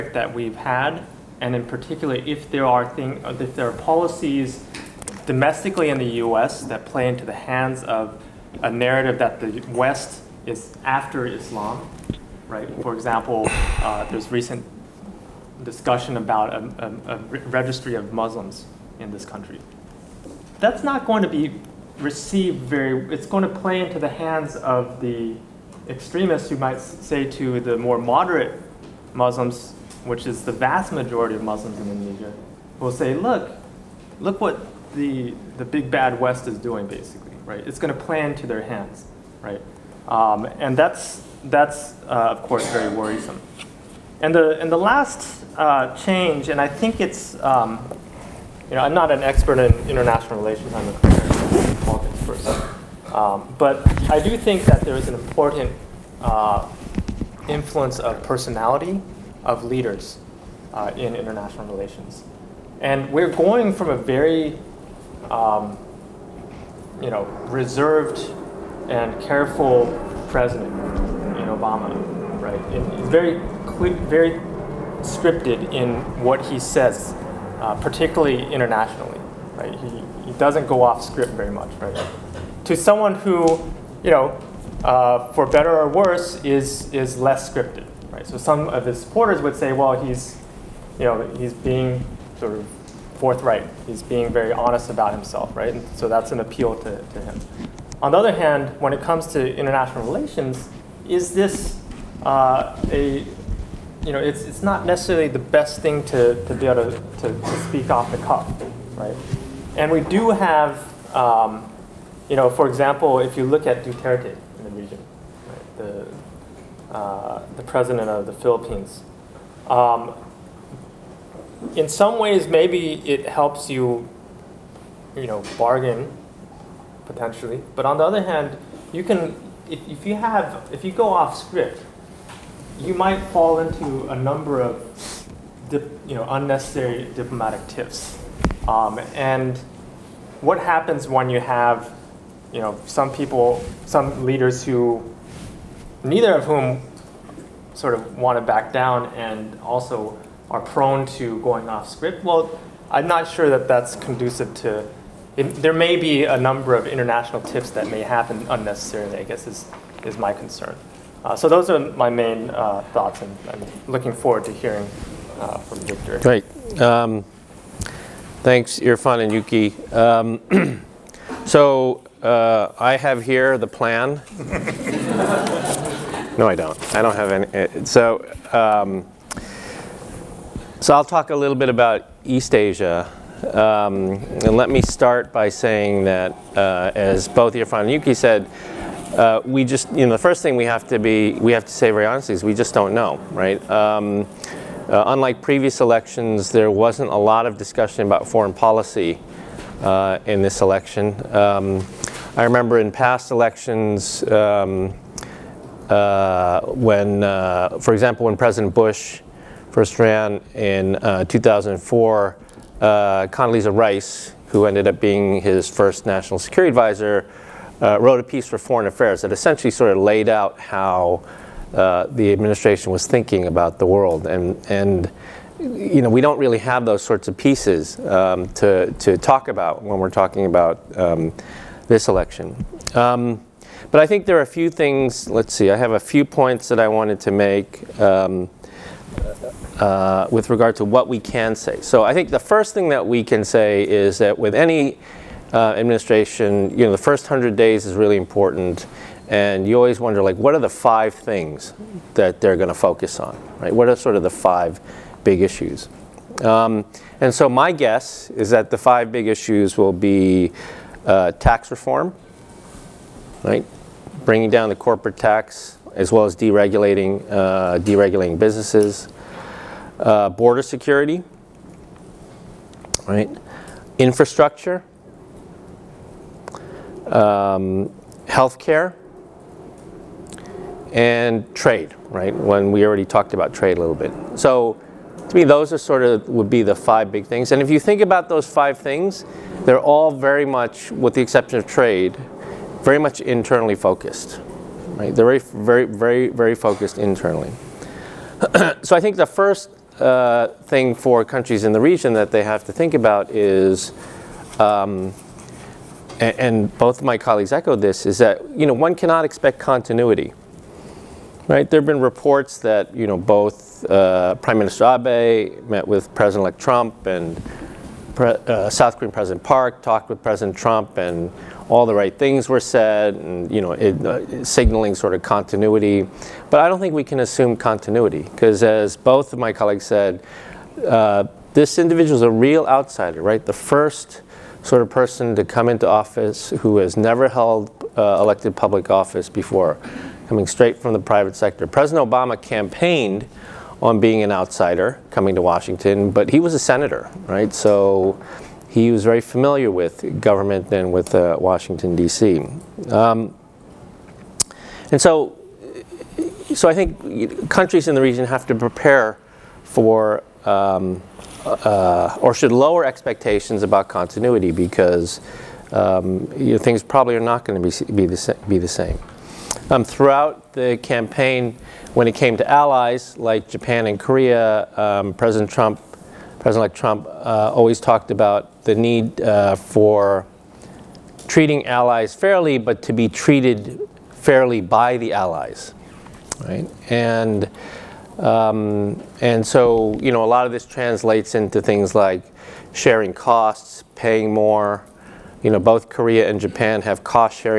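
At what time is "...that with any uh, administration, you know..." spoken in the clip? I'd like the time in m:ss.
4:04.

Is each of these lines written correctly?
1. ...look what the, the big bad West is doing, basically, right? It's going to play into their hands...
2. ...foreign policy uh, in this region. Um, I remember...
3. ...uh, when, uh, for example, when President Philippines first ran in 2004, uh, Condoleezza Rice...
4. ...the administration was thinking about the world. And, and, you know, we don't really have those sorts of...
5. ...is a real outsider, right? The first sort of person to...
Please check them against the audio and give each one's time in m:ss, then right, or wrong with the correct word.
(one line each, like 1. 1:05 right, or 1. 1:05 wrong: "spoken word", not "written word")
1. 0:34 right
2. 3:18 wrong: "election", not "region"
3. 3:25 wrong: "Bush", not "Philippines"
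4. 3:42 right
5. 5:32 right.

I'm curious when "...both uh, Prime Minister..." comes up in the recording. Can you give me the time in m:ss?
5:13.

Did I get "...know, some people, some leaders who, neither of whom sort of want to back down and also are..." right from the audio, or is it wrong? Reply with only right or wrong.
right.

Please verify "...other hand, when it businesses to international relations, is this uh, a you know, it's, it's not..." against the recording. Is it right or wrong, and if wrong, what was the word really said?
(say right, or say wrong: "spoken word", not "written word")
wrong: "comes", not "businesses".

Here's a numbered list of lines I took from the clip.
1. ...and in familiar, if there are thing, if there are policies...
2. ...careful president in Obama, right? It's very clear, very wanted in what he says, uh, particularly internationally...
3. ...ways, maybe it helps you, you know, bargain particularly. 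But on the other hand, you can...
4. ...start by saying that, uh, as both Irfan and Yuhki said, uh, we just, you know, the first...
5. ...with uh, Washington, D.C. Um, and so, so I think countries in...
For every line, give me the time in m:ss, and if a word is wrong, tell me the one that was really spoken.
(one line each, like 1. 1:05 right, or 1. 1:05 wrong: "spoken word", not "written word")
1. 0:01 wrong: "particular", not "familiar"
2. 1:09 wrong: "scripted", not "wanted"
3. 2:02 wrong: "potentially", not "particularly"
4. 3:04 right
5. 5:50 right.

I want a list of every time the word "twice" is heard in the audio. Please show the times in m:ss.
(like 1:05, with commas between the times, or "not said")
not said.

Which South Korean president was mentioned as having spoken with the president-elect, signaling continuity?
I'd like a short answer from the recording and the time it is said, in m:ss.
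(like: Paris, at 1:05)
President Park, at 5:19.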